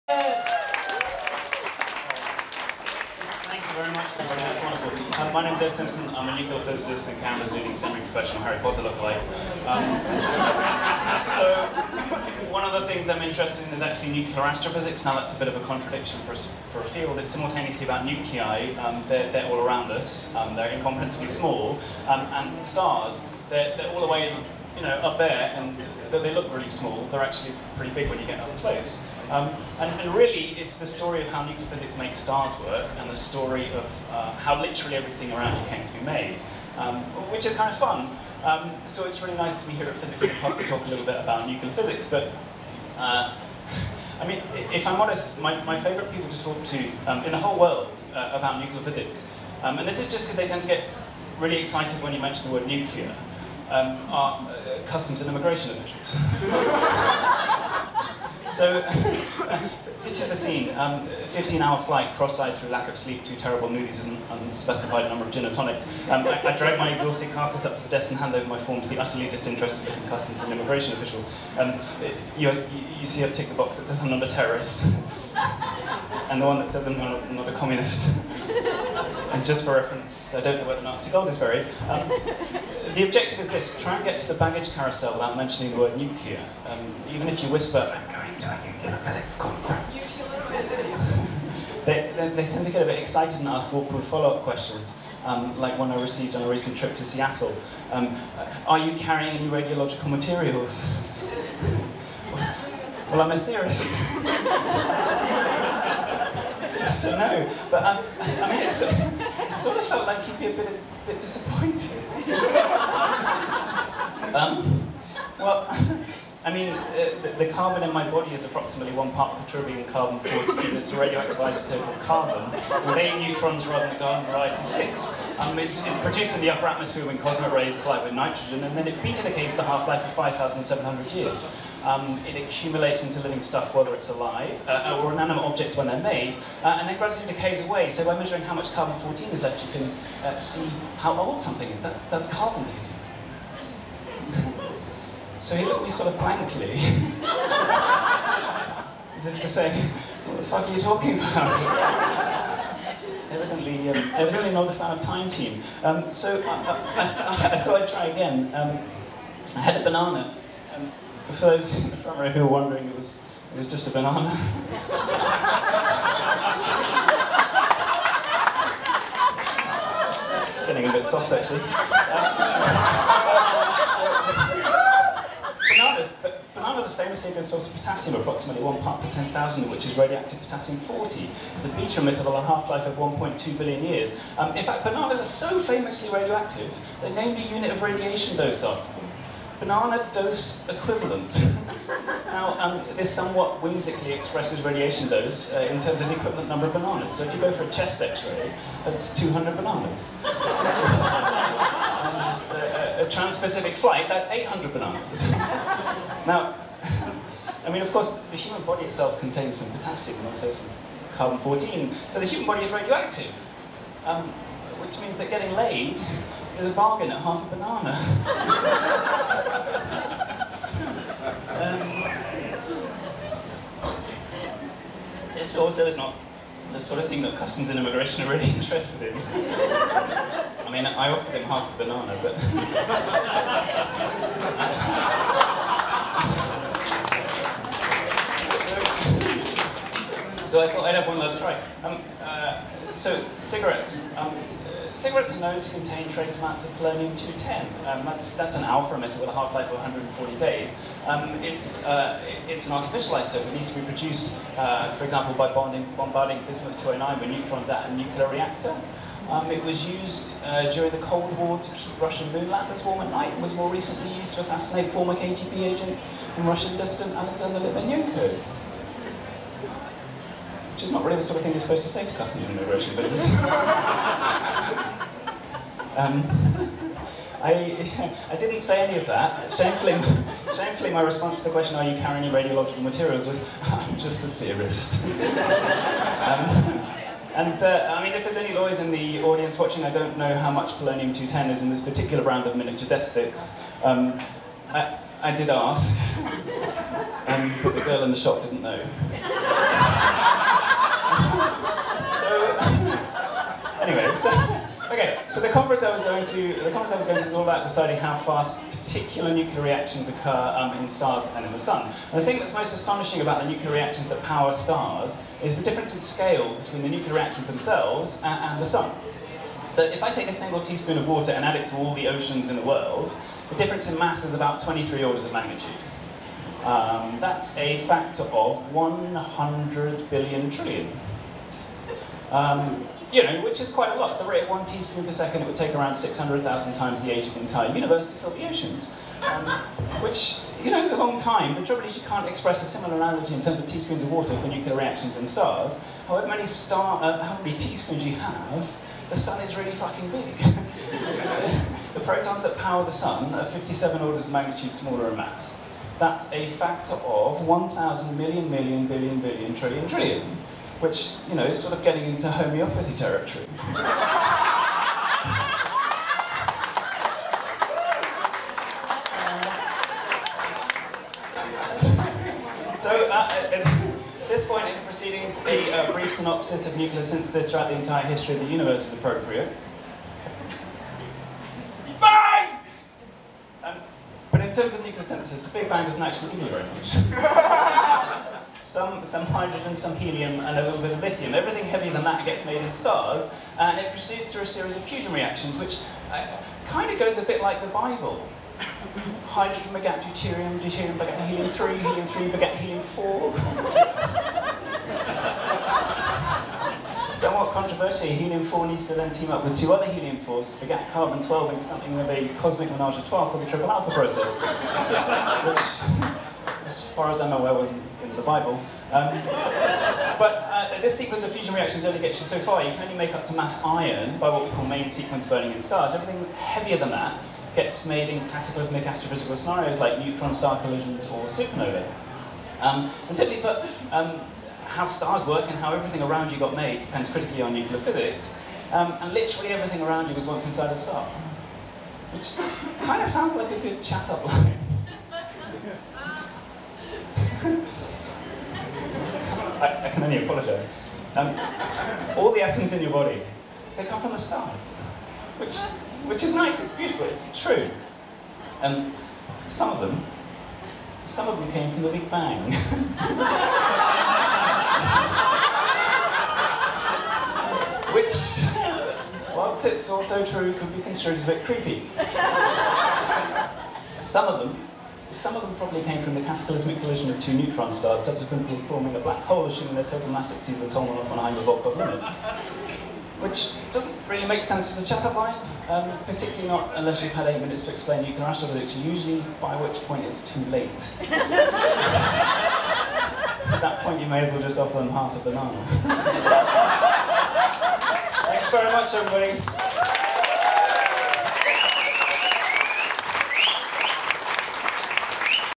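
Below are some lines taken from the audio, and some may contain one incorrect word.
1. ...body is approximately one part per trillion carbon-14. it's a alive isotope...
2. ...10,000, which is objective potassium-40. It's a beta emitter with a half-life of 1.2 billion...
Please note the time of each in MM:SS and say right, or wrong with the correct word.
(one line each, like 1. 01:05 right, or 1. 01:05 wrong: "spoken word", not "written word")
1. 01:58 wrong: "radioactive", not "alive"
2. 02:59 wrong: "radioactive", not "objective".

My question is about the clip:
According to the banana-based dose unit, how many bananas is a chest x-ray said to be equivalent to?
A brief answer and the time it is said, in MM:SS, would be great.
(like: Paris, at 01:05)
200, at 03:19.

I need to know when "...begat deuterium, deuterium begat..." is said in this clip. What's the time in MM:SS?
06:39.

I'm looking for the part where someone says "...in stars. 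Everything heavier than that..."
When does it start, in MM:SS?
07:05.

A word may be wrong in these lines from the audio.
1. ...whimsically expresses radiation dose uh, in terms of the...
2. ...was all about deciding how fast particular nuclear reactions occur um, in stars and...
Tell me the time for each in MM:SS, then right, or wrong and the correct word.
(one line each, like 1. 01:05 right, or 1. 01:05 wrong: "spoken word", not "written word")
1. 03:13 right
2. 05:07 right.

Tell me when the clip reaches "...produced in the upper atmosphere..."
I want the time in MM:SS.
02:05.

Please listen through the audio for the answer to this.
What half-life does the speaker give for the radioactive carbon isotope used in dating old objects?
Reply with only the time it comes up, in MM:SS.
02:10.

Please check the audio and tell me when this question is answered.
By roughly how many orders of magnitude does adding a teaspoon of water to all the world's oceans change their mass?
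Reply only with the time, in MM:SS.
05:24.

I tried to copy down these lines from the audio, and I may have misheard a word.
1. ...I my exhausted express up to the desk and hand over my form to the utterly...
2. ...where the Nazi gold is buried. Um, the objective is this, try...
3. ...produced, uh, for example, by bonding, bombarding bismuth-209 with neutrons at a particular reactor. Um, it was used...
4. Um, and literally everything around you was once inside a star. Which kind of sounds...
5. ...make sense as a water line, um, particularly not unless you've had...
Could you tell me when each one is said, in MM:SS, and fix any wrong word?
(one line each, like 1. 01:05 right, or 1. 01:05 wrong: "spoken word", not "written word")
1. 01:06 wrong: "carcass", not "express"
2. 01:20 right
3. 04:13 wrong: "nuclear", not "particular"
4. 07:18 right
5. 08:04 wrong: "chatter", not "water".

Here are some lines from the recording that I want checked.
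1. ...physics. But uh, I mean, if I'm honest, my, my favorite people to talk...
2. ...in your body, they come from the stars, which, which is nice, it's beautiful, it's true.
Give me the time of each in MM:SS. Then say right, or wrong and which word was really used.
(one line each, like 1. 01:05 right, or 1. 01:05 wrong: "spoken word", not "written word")
1. 00:41 right
2. 07:32 right.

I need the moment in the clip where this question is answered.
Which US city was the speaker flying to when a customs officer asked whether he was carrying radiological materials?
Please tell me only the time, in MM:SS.
01:37.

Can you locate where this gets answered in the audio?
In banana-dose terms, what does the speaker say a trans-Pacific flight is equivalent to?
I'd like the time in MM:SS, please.
03:24.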